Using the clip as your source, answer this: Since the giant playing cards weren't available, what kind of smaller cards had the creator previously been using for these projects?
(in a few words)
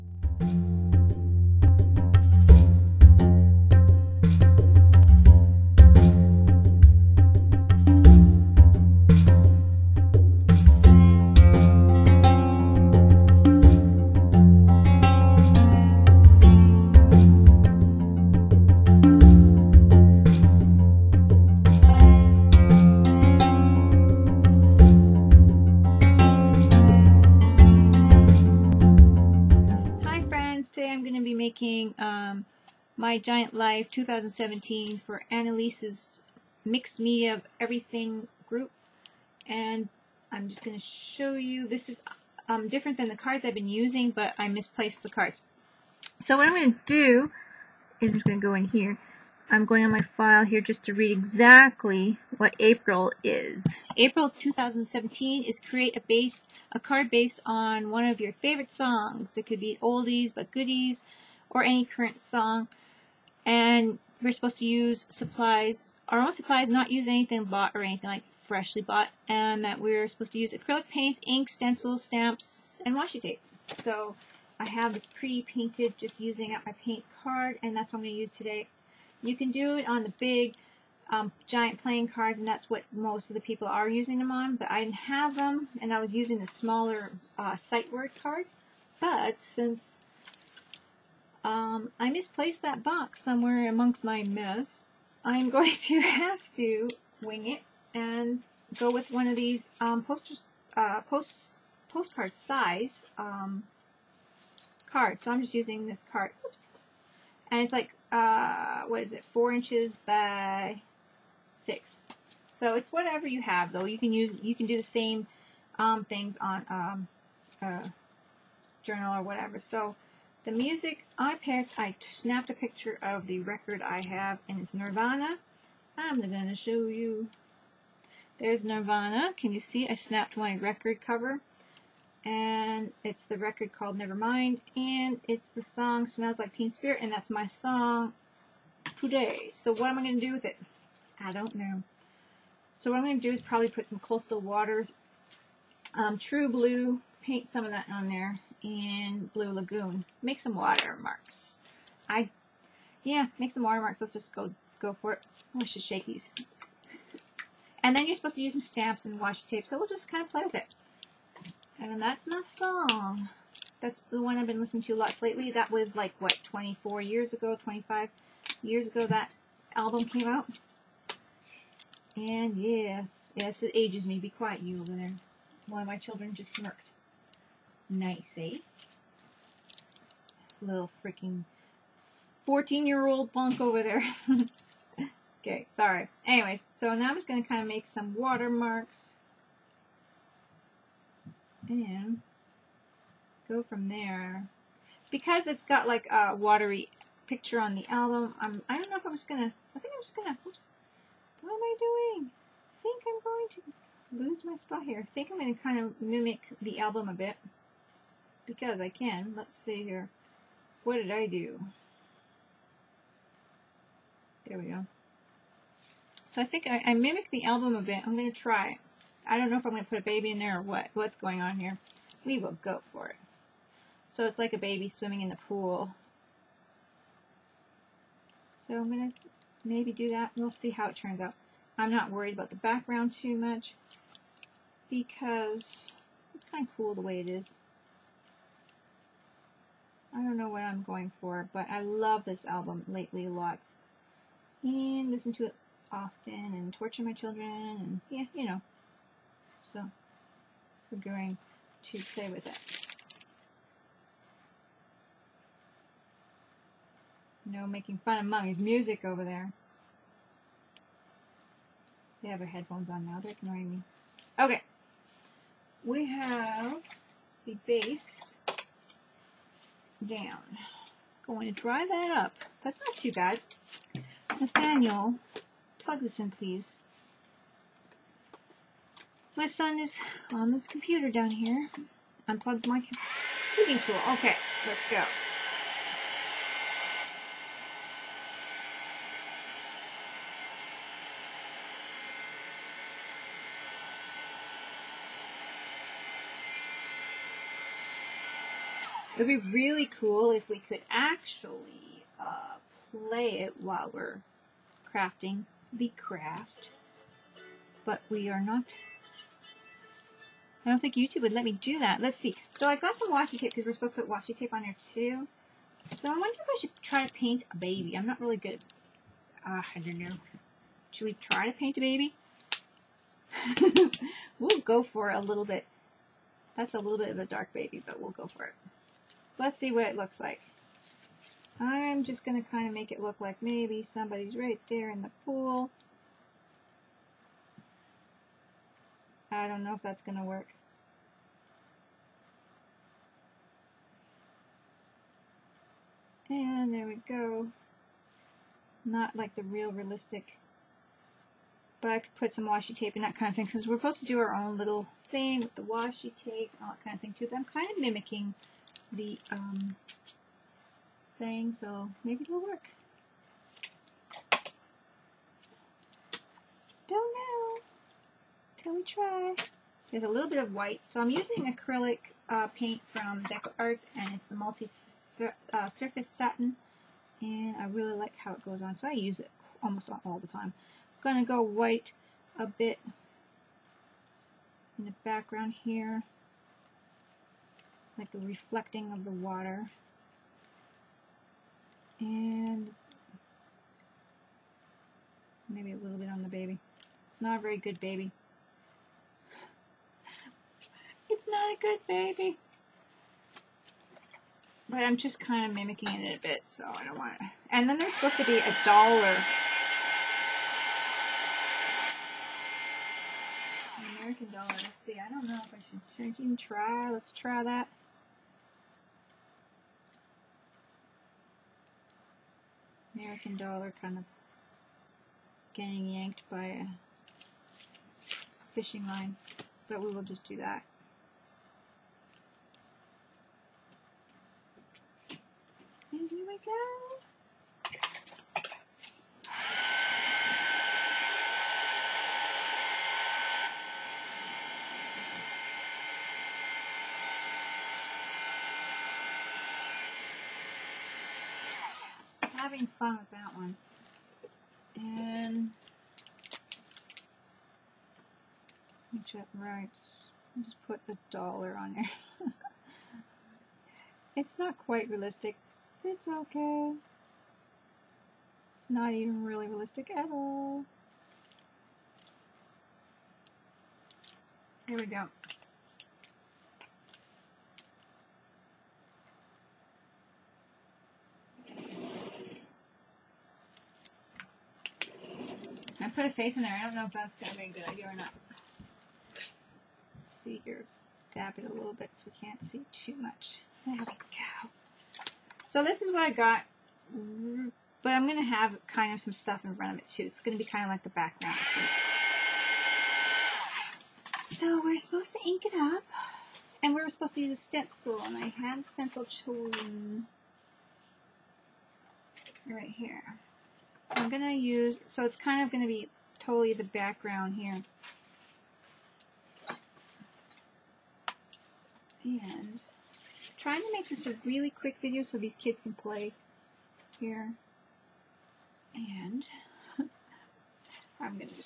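Sight word cards.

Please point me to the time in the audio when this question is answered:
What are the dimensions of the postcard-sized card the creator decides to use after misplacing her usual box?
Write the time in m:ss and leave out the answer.
1:49.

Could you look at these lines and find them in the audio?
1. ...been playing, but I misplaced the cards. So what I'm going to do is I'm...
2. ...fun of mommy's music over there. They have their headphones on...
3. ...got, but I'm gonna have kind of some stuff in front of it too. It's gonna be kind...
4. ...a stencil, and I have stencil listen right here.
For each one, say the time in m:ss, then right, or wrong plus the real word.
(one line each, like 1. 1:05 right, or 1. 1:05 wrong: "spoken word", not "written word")
1. 0:43 wrong: "using", not "playing"
2. 4:18 right
3. 8:16 right
4. 8:27 wrong: "chosen", not "listen".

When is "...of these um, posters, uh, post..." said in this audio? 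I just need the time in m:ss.
1:39.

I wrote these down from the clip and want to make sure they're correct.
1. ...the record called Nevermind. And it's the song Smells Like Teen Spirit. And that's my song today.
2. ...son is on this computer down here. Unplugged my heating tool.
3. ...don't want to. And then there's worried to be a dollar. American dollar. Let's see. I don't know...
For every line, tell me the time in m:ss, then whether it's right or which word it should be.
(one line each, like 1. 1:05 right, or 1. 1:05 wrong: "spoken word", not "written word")
1. 2:13 right
2. 4:39 right
3. 6:46 wrong: "supposed", not "worried".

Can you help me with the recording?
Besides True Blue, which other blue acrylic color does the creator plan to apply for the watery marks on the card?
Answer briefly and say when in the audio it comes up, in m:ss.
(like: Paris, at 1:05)
Blue Lagoon, at 2:29.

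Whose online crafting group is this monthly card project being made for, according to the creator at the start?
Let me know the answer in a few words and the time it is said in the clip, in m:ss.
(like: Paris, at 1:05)
Anneliese, at 0:35.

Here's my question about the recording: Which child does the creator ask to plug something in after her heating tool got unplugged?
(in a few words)
Nathaniel.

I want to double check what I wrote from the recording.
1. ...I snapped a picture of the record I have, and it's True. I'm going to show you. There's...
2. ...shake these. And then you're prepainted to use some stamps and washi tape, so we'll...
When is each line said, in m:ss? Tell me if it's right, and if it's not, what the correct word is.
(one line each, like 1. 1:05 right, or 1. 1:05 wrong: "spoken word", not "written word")
1. 2:01 wrong: "Nirvana", not "True"
2. 2:35 wrong: "supposed", not "prepainted".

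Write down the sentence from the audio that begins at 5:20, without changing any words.
Should we try to paint a baby?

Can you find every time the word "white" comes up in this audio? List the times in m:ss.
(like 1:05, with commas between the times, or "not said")
6:10, 6:21.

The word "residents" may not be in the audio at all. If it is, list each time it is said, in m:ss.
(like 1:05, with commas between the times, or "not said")
not said.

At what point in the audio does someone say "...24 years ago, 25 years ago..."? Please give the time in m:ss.
2:46.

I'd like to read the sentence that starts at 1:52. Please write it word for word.
So it's whatever you have, though.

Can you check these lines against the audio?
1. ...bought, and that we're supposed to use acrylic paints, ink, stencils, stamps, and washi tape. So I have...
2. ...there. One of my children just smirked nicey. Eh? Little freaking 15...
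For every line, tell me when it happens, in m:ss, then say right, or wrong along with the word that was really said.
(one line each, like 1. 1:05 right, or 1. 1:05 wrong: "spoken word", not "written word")
1. 1:08 right
2. 2:54 wrong: "14", not "15".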